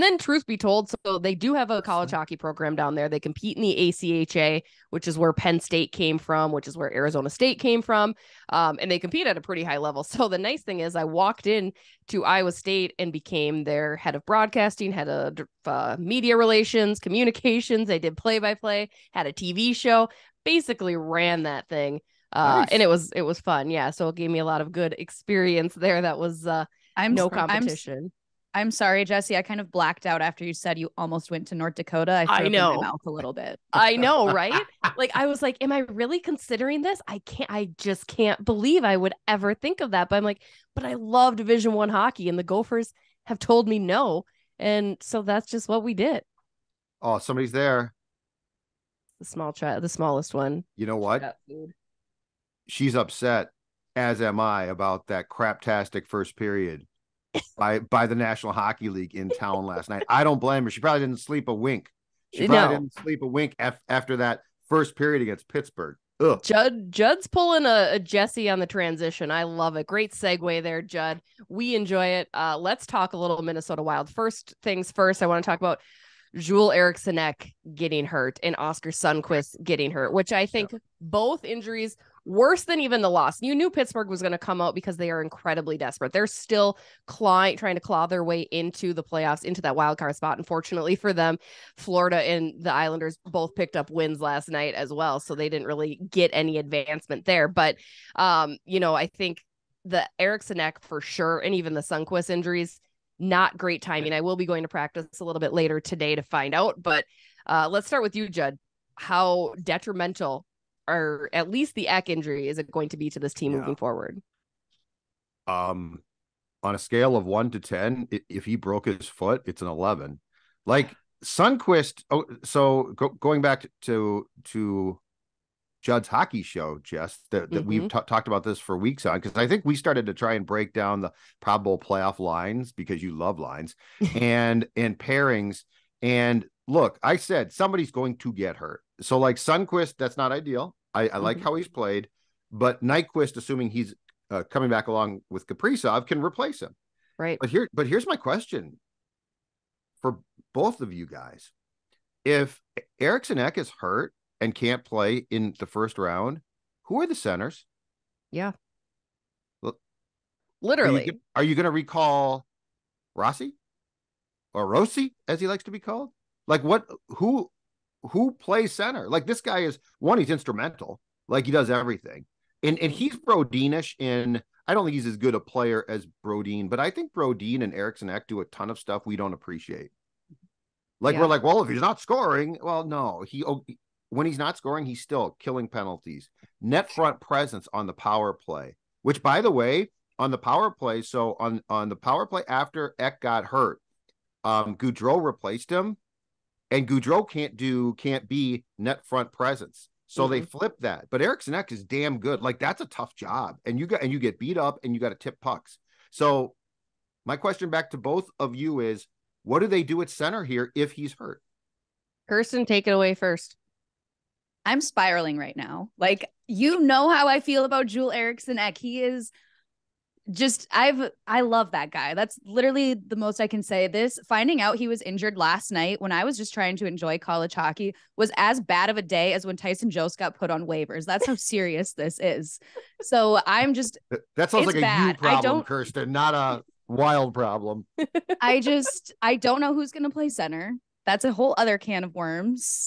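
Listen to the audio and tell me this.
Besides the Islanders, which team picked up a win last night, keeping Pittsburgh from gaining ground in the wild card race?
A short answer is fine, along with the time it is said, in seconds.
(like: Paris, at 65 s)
Florida, at 91 s.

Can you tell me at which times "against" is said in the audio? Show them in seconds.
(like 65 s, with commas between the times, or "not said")
65 s.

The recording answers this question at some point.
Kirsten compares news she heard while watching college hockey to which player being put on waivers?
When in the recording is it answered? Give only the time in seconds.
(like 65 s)
229 s.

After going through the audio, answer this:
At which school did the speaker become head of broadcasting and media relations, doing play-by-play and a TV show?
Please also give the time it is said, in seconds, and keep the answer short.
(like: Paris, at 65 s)
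Iowa State, at 12 s.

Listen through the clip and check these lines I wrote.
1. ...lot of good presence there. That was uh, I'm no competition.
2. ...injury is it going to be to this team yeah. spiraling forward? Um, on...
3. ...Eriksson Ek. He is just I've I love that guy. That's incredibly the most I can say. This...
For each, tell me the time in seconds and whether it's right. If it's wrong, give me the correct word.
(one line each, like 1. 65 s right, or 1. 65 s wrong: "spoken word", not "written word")
1. 24 s wrong: "experience", not "presence"
2. 112 s wrong: "moving", not "spiraling"
3. 218 s wrong: "literally", not "incredibly".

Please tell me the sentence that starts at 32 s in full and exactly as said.
I, I know mouth a little bit.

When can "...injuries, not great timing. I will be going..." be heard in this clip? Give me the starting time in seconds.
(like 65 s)
102 s.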